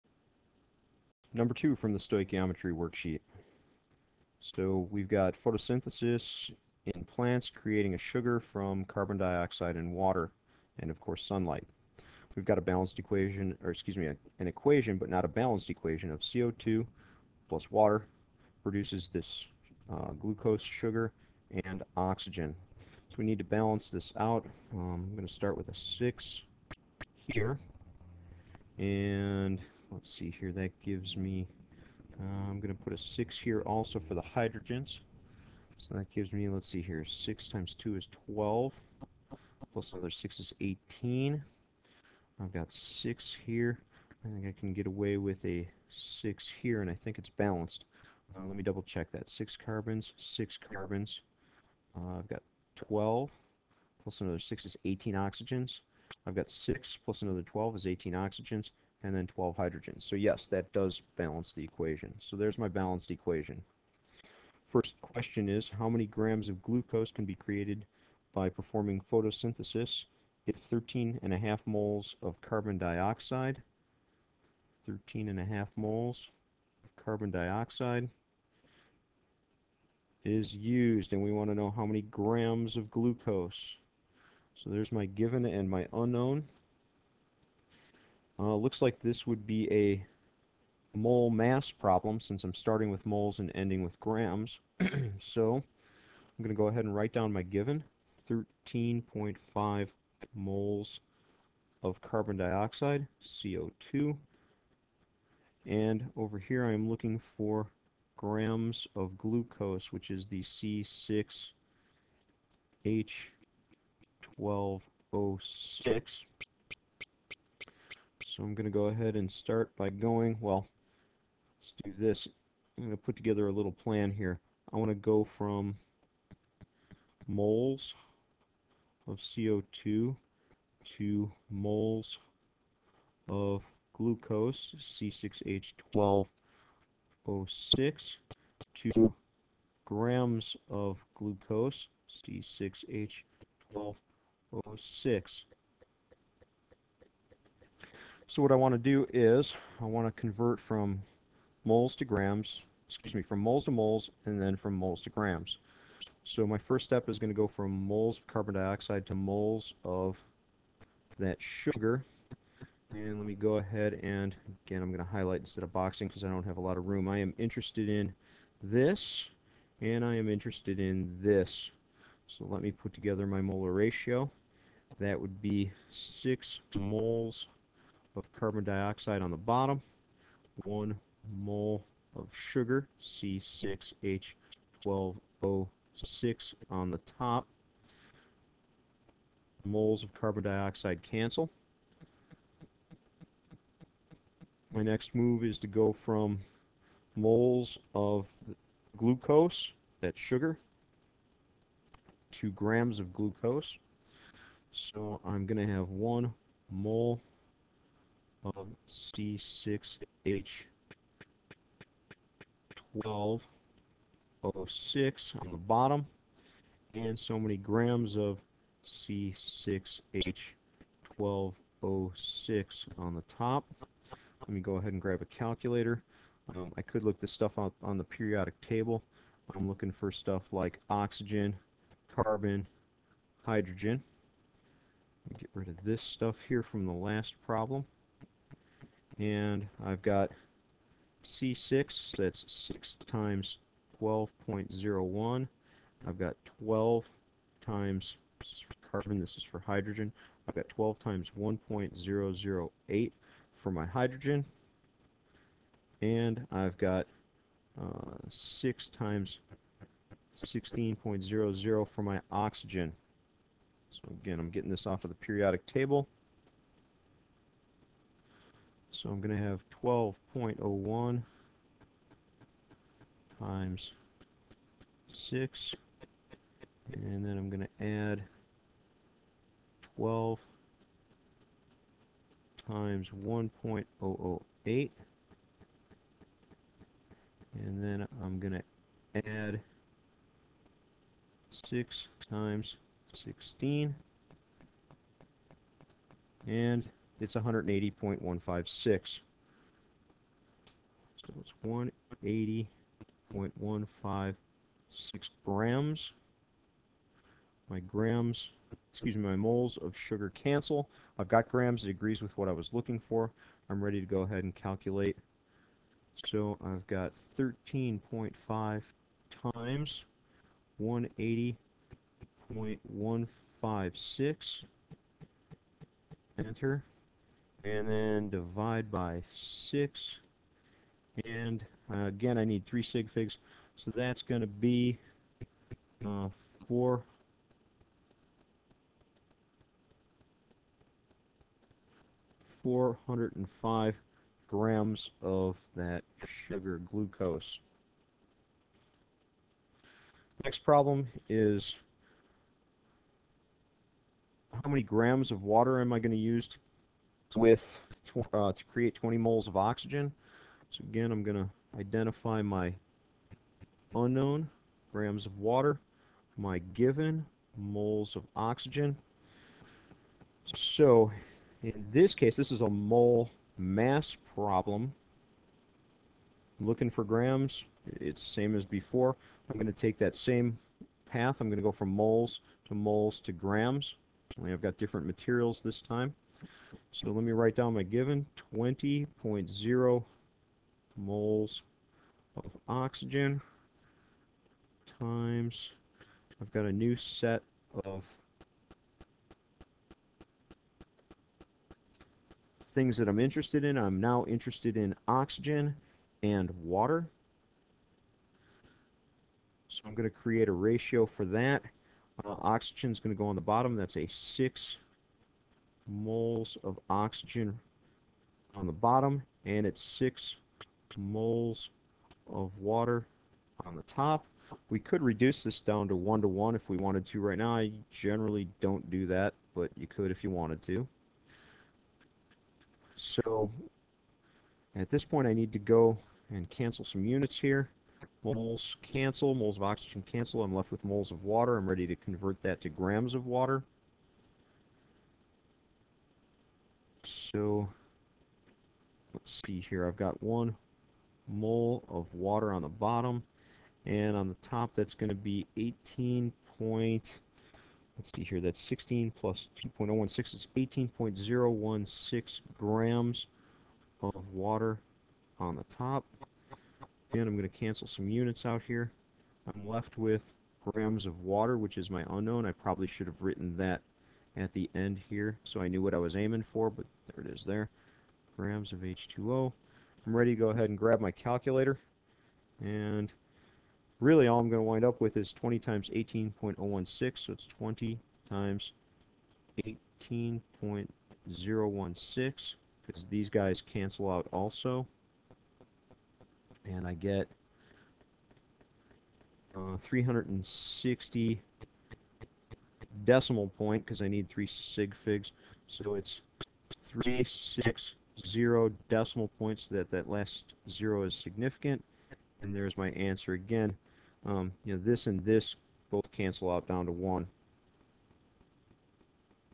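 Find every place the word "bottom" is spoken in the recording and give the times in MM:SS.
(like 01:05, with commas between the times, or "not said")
02:59, 03:35, 06:53, 06:58, 07:32.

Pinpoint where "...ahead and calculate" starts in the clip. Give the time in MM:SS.
05:14.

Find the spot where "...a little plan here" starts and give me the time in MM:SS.
02:03.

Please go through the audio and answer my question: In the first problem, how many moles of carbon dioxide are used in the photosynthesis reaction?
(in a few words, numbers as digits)
13.5.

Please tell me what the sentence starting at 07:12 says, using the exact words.
So at this point I need to go and cancel some units here.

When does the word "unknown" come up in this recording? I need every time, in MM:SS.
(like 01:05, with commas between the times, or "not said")
01:25, 06:03, 07:52.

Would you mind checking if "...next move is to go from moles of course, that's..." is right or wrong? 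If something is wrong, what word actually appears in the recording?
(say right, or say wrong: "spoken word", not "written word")
wrong: "glucose", not "course".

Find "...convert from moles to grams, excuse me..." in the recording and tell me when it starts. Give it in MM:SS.
02:30.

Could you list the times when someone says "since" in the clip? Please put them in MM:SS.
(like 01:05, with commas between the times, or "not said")
01:32.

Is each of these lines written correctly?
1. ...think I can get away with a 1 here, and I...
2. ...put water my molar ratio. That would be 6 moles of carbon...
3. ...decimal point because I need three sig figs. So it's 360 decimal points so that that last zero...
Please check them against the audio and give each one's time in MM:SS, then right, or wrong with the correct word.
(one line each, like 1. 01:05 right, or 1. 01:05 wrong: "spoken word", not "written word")
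1. 00:44 wrong: "6", not "1"
2. 02:52 wrong: "together", not "water"
3. 08:23 right.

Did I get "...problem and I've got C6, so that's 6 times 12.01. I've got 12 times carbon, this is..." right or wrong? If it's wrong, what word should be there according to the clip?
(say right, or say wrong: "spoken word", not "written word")
right.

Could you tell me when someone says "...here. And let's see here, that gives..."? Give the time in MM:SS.
00:27.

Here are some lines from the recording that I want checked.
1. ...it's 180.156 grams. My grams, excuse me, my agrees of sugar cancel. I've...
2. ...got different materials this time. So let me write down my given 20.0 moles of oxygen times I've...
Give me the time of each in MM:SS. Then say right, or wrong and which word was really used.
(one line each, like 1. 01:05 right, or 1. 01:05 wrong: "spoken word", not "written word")
1. 05:01 wrong: "moles", not "agrees"
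2. 06:24 right.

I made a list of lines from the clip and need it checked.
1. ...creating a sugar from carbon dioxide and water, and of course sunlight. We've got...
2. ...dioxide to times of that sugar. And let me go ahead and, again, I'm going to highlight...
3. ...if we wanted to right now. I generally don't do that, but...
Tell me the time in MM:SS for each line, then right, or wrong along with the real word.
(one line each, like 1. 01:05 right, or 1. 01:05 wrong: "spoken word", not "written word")
1. 00:07 right
2. 02:38 wrong: "moles", not "times"
3. 07:06 right.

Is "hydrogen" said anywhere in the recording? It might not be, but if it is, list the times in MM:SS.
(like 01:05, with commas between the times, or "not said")
00:34, 00:59, 03:53, 04:09, 04:13.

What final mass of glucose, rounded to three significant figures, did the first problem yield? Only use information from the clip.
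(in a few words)
405 grams.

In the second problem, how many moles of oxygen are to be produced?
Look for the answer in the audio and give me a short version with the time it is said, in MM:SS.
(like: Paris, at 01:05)
20, at 05:58.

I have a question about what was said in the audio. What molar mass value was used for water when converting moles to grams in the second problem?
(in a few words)
18.016 grams.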